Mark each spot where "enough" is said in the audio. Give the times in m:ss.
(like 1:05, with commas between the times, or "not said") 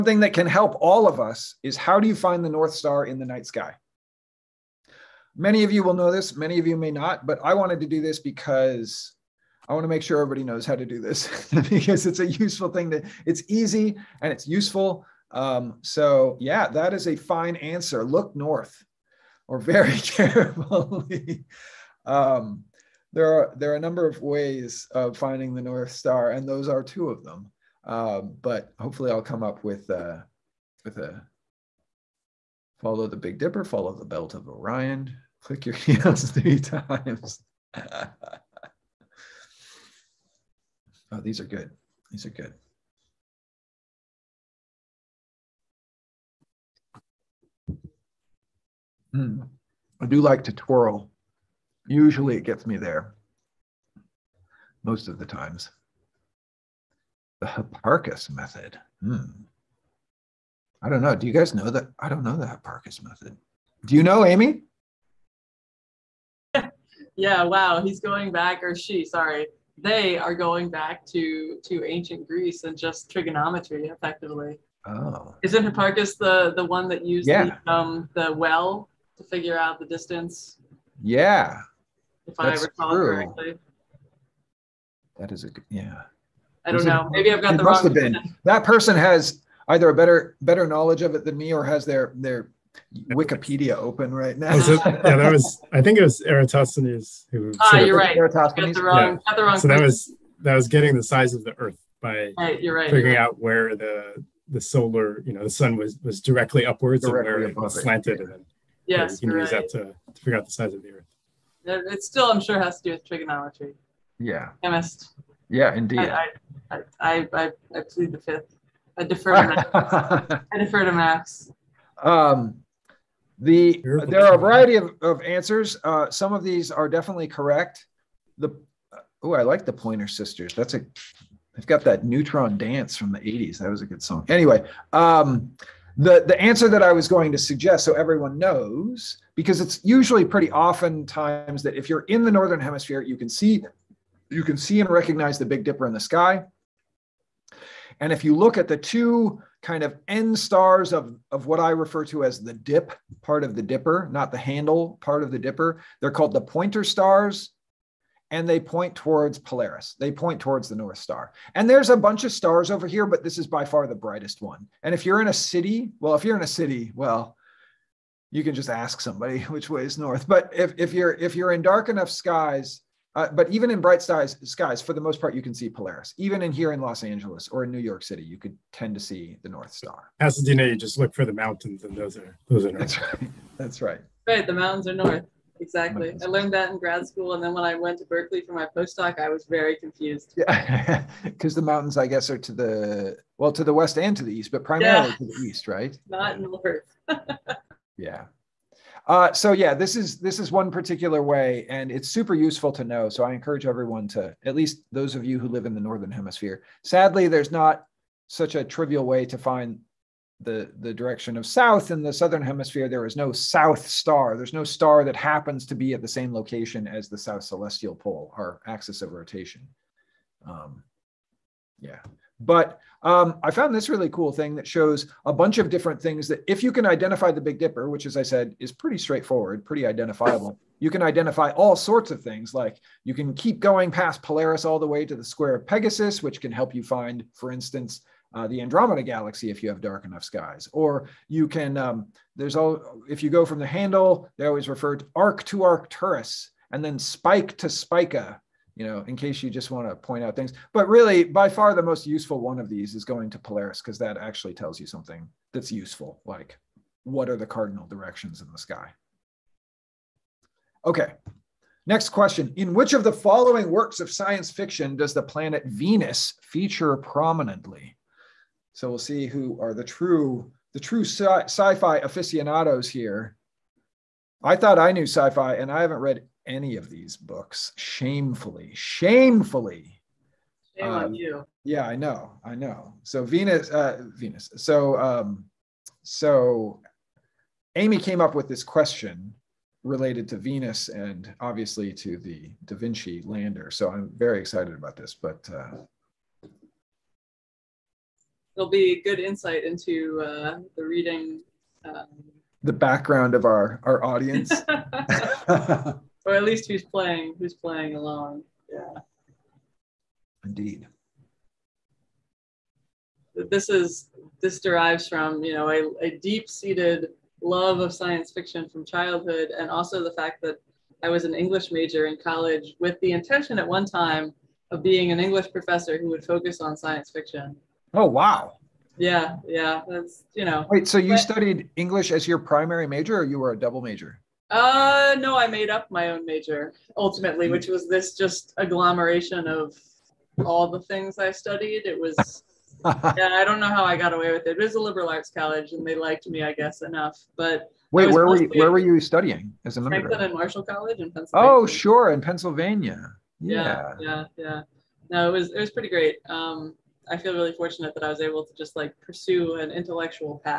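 2:51, 4:00, 5:46.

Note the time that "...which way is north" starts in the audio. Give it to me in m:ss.
2:49.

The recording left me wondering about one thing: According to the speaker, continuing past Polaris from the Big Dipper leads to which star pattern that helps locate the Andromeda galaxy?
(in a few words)
square of Pegasus.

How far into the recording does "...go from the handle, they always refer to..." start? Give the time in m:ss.
4:03.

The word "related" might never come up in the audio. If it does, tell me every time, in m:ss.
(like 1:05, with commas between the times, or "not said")
4:49.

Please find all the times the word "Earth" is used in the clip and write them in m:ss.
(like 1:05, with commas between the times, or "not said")
1:41, 1:50.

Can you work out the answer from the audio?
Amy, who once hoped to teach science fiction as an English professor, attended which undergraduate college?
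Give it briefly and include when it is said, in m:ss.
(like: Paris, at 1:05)
Franklin and Marshall College, at 5:50.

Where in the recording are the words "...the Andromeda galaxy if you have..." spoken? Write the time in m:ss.
3:58.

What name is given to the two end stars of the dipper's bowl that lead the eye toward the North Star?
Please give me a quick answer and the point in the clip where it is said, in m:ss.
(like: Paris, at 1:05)
pointer stars, at 2:36.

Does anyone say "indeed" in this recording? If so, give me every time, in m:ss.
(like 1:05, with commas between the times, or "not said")
1:55, 5:10.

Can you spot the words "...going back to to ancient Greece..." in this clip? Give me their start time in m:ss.
1:10.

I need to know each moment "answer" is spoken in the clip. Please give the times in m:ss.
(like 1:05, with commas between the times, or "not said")
0:17, 2:05, 2:16.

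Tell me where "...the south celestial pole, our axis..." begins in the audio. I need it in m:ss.
3:37.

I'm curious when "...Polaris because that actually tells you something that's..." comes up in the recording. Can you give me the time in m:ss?
4:13.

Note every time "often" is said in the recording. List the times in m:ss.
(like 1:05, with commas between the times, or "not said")
2:20.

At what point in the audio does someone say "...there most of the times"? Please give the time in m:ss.
0:52.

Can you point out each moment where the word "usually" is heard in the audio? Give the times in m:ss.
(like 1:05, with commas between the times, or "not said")
0:51, 2:19.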